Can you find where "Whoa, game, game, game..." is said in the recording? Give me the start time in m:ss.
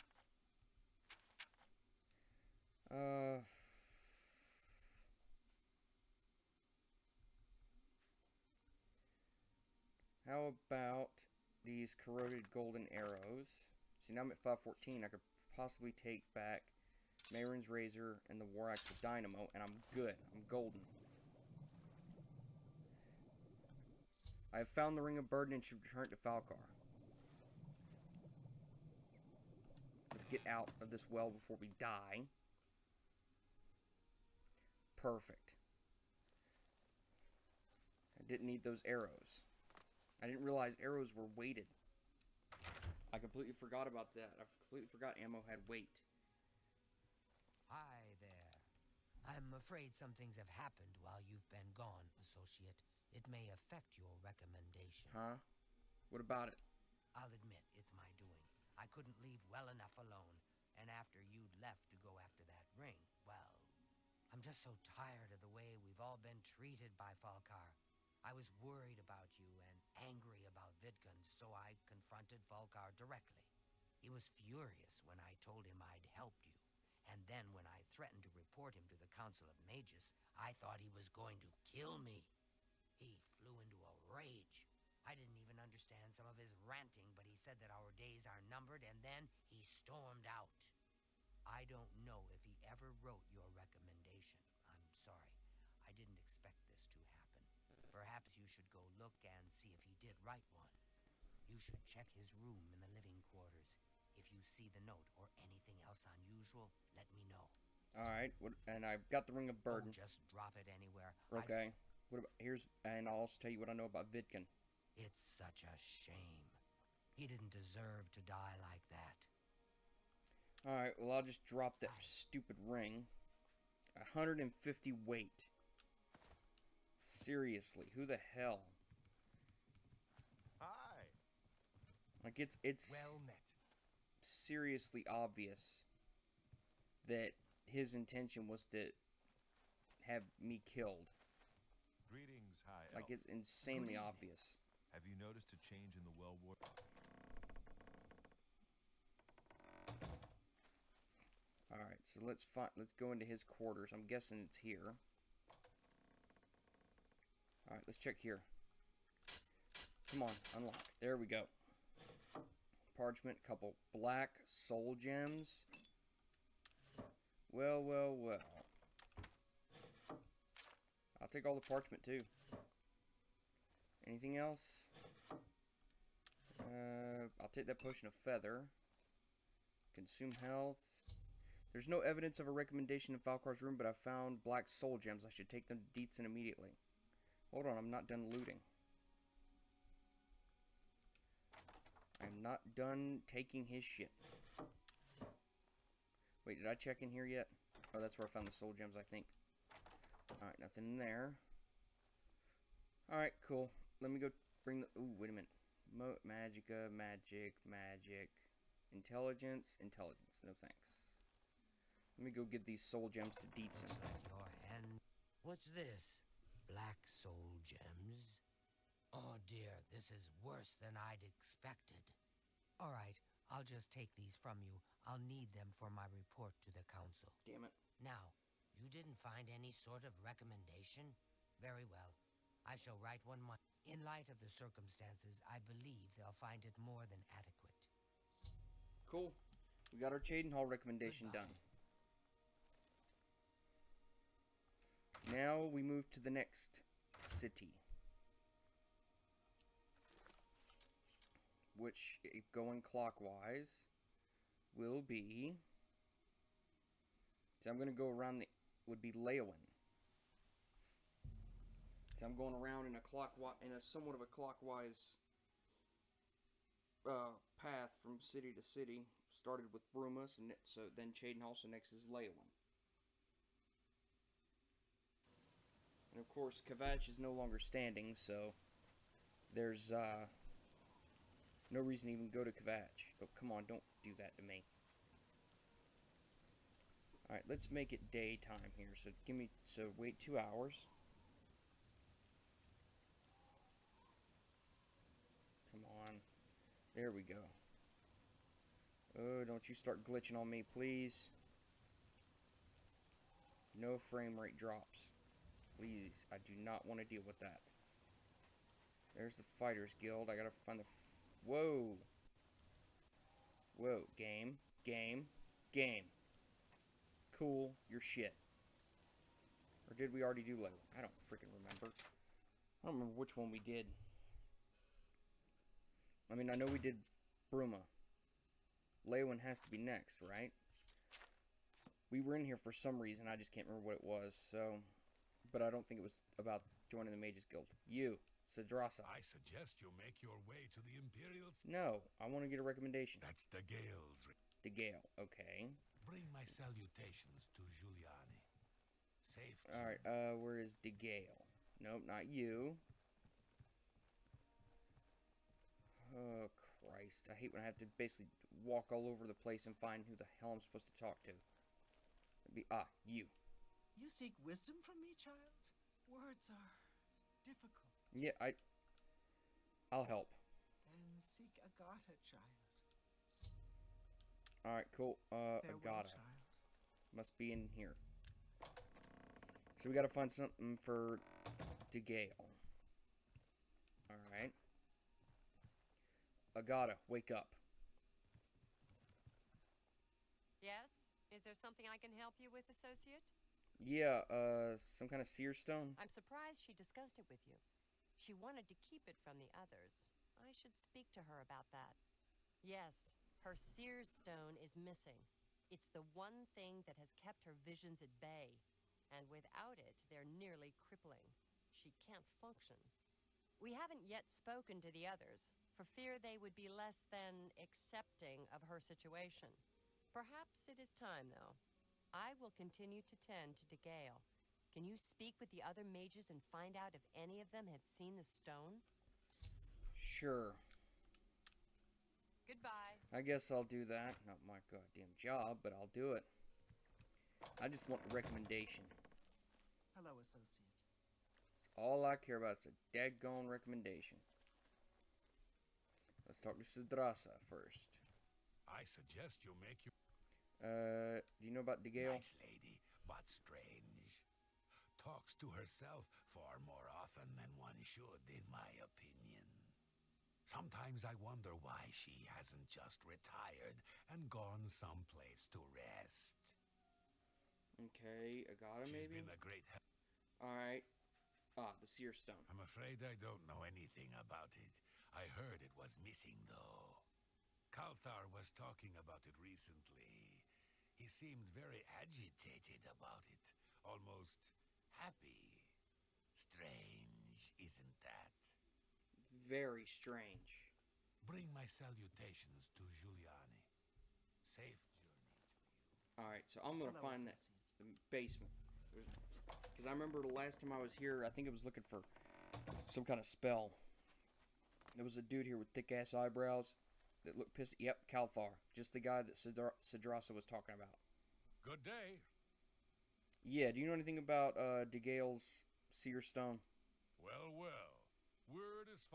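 5:13.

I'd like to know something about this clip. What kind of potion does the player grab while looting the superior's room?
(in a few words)
Feather.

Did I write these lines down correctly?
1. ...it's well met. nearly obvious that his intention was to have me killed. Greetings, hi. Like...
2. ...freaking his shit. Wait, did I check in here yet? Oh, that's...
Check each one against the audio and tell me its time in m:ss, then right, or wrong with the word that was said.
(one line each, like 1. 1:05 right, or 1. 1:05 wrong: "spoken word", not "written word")
1. 2:12 wrong: "seriously", not "nearly"
2. 3:13 wrong: "taking", not "freaking".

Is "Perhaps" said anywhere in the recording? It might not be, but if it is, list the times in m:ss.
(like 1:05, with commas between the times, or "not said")
1:37, 7:00.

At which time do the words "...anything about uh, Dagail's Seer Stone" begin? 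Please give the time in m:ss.
8:33.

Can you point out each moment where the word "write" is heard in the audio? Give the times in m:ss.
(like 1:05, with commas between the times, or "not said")
1:40, 3:52.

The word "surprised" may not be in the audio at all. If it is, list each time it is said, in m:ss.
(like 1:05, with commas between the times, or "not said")
6:36.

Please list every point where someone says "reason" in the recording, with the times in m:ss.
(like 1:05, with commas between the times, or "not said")
4:41, 5:33.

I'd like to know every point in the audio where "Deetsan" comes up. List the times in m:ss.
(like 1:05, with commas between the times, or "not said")
3:06, 3:33.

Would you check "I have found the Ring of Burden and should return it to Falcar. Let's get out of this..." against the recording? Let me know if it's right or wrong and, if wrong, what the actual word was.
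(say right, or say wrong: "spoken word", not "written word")
right.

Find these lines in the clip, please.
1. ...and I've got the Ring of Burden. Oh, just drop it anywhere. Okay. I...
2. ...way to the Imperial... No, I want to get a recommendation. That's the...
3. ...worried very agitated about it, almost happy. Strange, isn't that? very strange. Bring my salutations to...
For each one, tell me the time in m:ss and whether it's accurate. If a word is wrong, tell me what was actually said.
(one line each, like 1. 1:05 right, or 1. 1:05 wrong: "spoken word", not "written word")
1. 1:48 right
2. 5:40 right
3. 8:01 wrong: "seemed", not "worried".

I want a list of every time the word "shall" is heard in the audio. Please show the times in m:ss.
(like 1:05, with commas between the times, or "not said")
3:52.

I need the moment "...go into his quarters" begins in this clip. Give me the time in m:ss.
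2:32.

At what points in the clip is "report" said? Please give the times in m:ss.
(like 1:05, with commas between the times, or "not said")
1:18, 3:46.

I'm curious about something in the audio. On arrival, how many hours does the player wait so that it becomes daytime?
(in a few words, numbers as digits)
2.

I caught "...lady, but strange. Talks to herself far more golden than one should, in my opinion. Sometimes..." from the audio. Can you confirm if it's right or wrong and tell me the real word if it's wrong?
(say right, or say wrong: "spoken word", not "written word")
wrong: "often", not "golden".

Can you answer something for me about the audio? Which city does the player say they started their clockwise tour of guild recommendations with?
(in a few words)
Bruma.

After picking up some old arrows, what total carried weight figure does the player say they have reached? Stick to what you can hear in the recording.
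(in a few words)
514.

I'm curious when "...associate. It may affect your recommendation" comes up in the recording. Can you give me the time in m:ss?
0:52.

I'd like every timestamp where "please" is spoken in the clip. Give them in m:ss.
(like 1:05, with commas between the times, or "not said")
5:00, 5:05.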